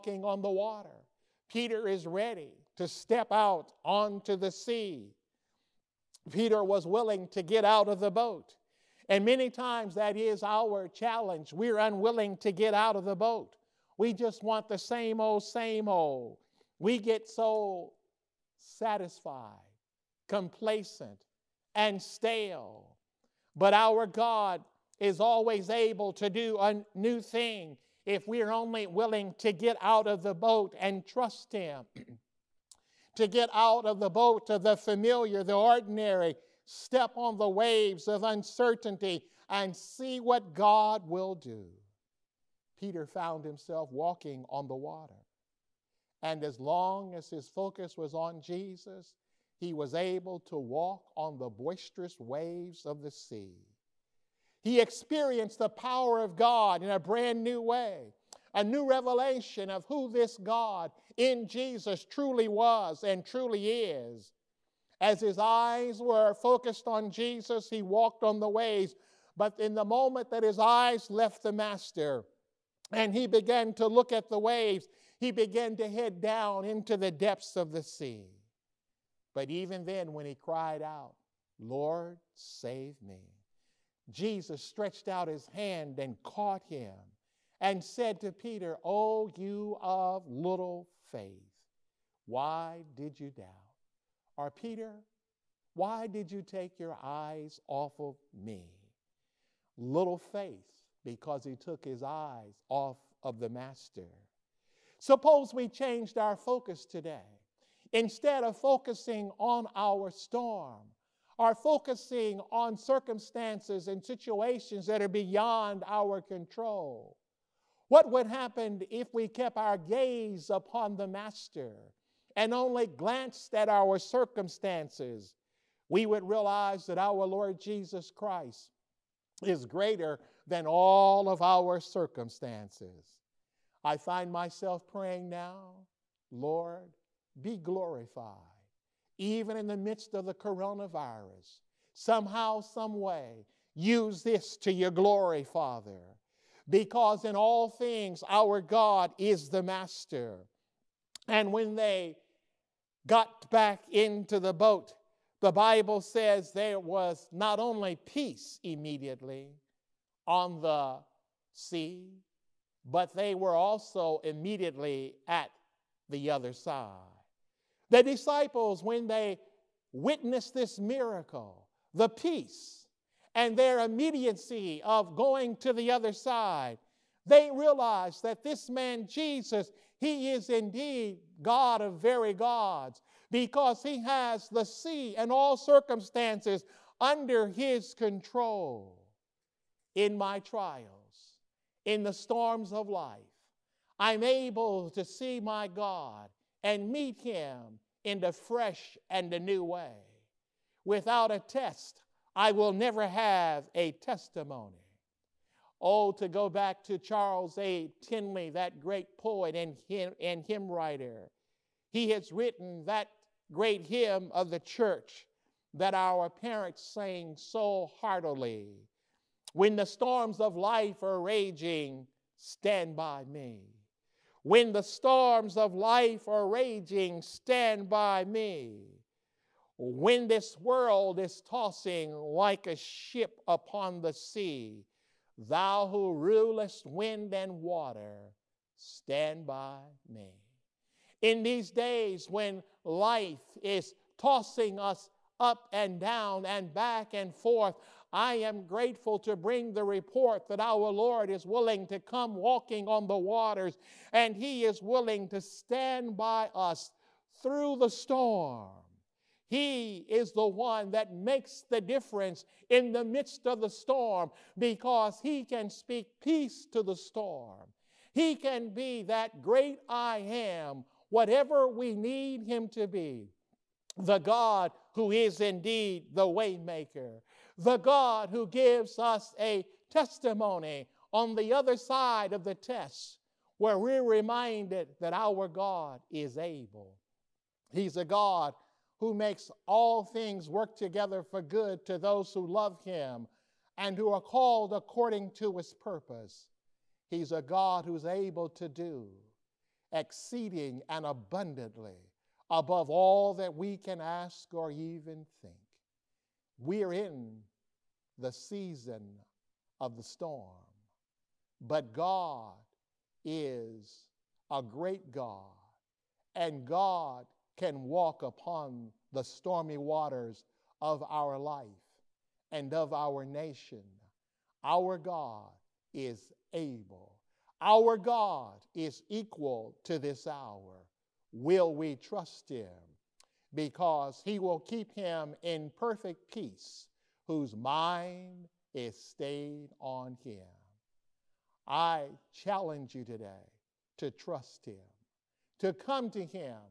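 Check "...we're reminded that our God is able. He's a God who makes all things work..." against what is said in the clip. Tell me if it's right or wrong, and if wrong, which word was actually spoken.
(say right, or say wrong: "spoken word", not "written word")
right.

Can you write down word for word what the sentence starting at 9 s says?
And many times that is our challenge.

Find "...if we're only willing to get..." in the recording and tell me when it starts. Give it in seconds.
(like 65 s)
28 s.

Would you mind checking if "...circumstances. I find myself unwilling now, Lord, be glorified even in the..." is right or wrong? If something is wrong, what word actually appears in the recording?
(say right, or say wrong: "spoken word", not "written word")
wrong: "praying", not "unwilling".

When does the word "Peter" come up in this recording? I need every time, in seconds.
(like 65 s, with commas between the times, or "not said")
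1 s, 6 s, 42 s, 88 s, 94 s.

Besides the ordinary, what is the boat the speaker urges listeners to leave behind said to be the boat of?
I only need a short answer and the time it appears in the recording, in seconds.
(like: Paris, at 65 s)
the familiar, at 34 s.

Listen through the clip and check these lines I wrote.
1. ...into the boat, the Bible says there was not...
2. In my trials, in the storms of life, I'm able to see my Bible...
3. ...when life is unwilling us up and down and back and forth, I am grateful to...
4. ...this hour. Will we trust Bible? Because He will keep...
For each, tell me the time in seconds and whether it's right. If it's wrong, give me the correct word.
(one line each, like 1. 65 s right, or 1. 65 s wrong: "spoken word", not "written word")
1. 153 s right
2. 189 s wrong: "God", not "Bible"
3. 242 s wrong: "tossing", not "unwilling"
4. 329 s wrong: "Him", not "Bible".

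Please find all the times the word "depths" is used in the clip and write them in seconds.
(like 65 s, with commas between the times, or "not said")
77 s.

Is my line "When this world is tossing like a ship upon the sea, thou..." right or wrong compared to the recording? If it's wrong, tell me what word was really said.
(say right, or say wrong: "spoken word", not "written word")
right.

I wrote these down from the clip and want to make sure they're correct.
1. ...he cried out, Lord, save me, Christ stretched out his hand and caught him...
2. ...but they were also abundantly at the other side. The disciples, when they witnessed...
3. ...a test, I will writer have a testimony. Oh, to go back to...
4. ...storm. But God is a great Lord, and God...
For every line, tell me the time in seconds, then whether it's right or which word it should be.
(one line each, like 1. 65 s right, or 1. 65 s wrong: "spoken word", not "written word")
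1. 80 s wrong: "Jesus", not "Christ"
2. 162 s wrong: "immediately", not "abundantly"
3. 201 s wrong: "never", not "writer"
4. 310 s wrong: "God", not "Lord".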